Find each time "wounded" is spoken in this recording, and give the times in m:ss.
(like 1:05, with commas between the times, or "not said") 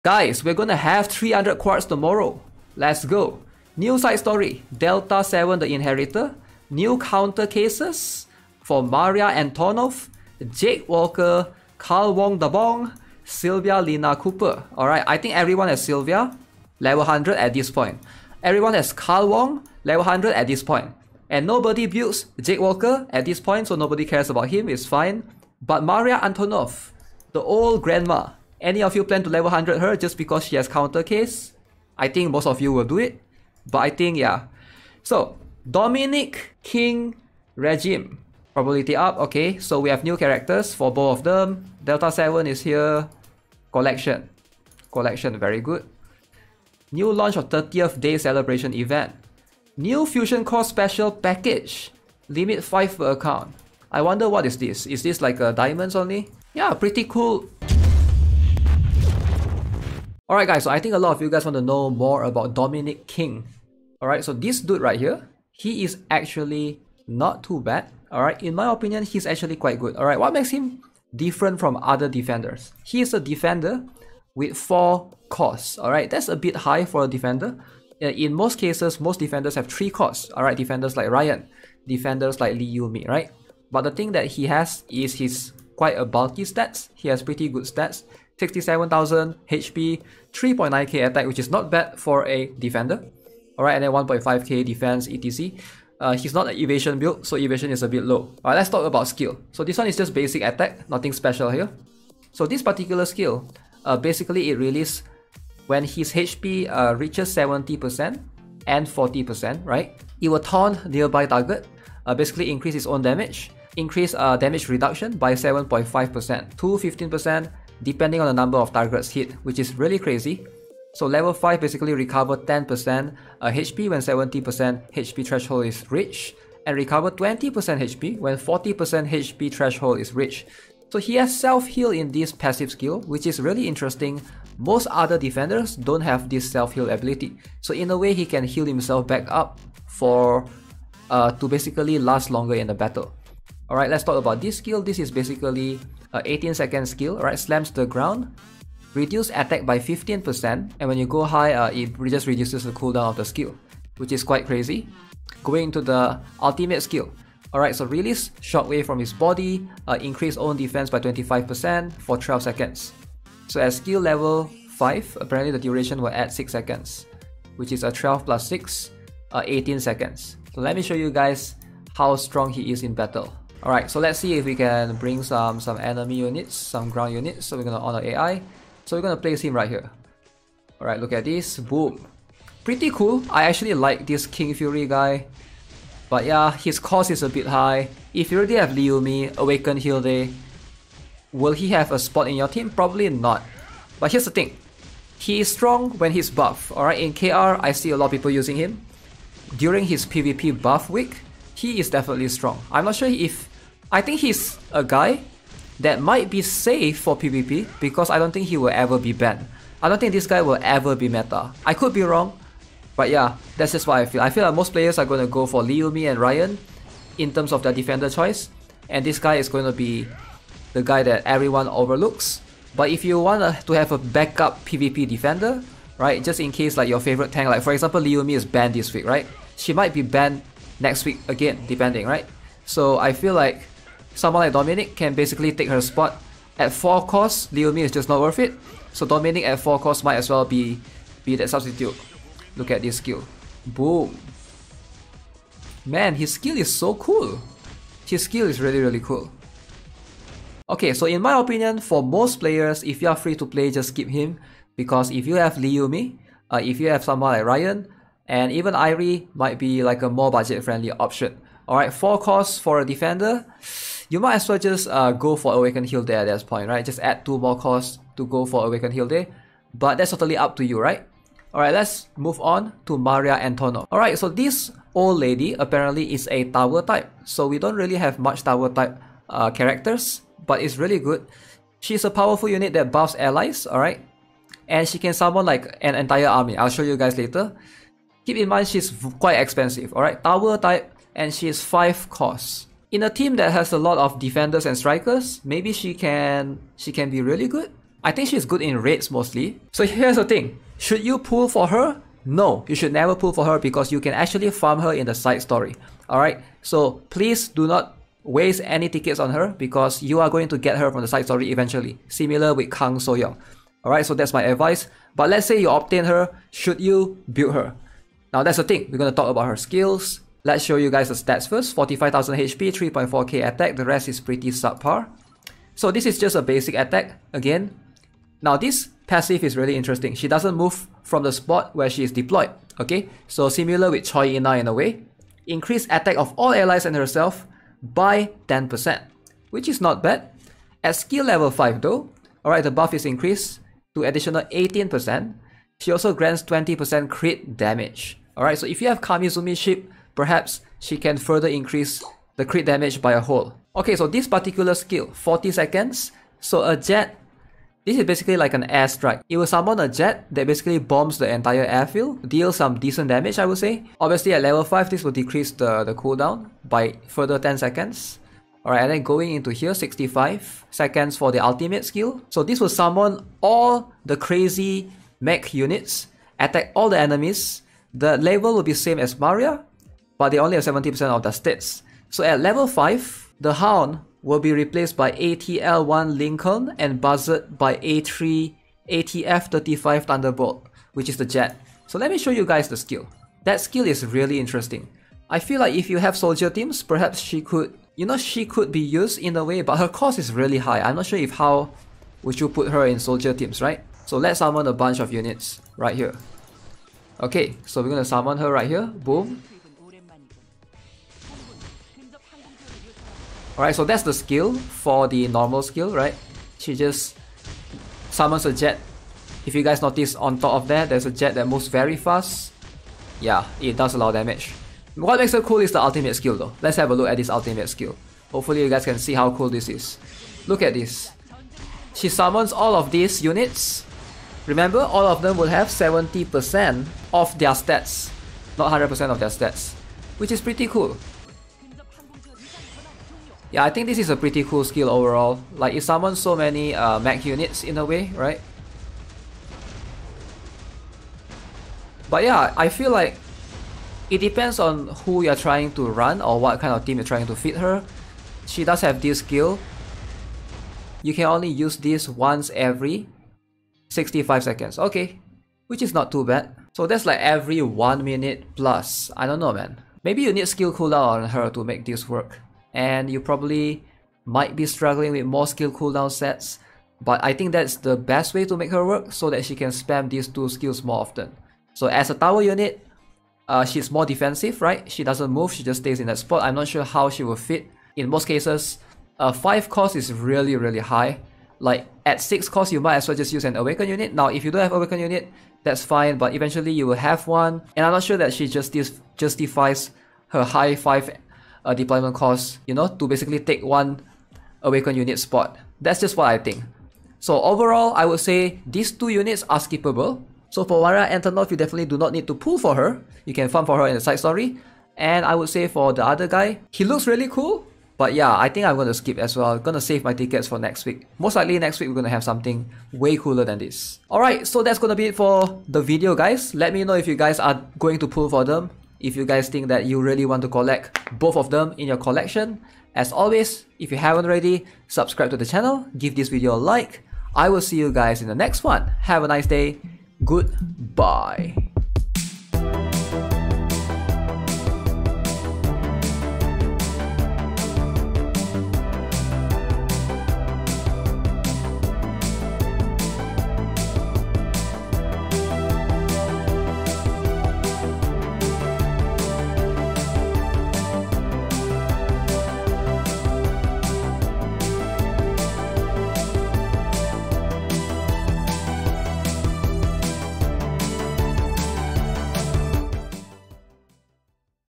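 not said.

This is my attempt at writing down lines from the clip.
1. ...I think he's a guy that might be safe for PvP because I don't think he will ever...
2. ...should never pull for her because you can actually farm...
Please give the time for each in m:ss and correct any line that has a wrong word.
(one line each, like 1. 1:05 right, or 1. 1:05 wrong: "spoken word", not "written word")
1. 3:23 right
2. 5:02 right.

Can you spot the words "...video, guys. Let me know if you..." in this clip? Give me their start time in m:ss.
8:45.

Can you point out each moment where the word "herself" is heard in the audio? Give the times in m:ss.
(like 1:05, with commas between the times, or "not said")
5:36.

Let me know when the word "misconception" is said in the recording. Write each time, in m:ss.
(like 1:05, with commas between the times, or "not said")
not said.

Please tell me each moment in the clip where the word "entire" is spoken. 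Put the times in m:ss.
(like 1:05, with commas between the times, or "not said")
4:45, 6:01.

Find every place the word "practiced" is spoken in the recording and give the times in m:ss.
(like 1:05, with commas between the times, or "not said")
not said.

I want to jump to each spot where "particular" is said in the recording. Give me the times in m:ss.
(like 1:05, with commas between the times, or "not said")
1:42, 5:54.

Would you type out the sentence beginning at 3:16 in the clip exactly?
Alright, in KR, I see a lot of people using him.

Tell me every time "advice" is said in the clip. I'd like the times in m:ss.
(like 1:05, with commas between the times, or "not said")
5:14.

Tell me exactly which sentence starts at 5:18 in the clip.
Now that's the thing, we're going to talk about her skills, Let's show you guys the stats first.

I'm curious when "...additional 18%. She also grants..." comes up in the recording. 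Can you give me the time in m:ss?
5:44.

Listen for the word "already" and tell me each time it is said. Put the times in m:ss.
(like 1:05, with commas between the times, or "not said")
3:08, 8:54.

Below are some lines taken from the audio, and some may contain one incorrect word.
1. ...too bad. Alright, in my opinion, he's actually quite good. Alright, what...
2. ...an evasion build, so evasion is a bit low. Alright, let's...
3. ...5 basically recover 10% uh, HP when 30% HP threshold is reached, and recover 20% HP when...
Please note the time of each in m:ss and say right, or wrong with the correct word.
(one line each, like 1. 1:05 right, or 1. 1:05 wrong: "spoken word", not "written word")
1. 1:07 right
2. 1:36 right
3. 2:01 wrong: "70", not "30".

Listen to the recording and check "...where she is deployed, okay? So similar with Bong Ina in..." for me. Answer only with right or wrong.
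wrong.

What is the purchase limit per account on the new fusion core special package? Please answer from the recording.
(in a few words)
5.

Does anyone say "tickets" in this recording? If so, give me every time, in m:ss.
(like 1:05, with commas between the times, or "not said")
5:08, 8:40.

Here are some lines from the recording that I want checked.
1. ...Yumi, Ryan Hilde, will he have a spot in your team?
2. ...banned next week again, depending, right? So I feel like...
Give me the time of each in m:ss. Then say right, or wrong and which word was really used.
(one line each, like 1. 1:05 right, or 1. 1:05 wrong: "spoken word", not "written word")
1. 3:08 wrong: "Awaken", not "Ryan"
2. 3:50 right.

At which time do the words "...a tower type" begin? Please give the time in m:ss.
4:36.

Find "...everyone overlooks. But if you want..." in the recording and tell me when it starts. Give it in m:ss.
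3:41.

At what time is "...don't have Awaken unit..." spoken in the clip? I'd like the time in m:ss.
8:14.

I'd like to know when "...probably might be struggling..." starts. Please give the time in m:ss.
7:53.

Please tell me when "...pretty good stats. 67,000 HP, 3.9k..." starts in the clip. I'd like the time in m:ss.
1:27.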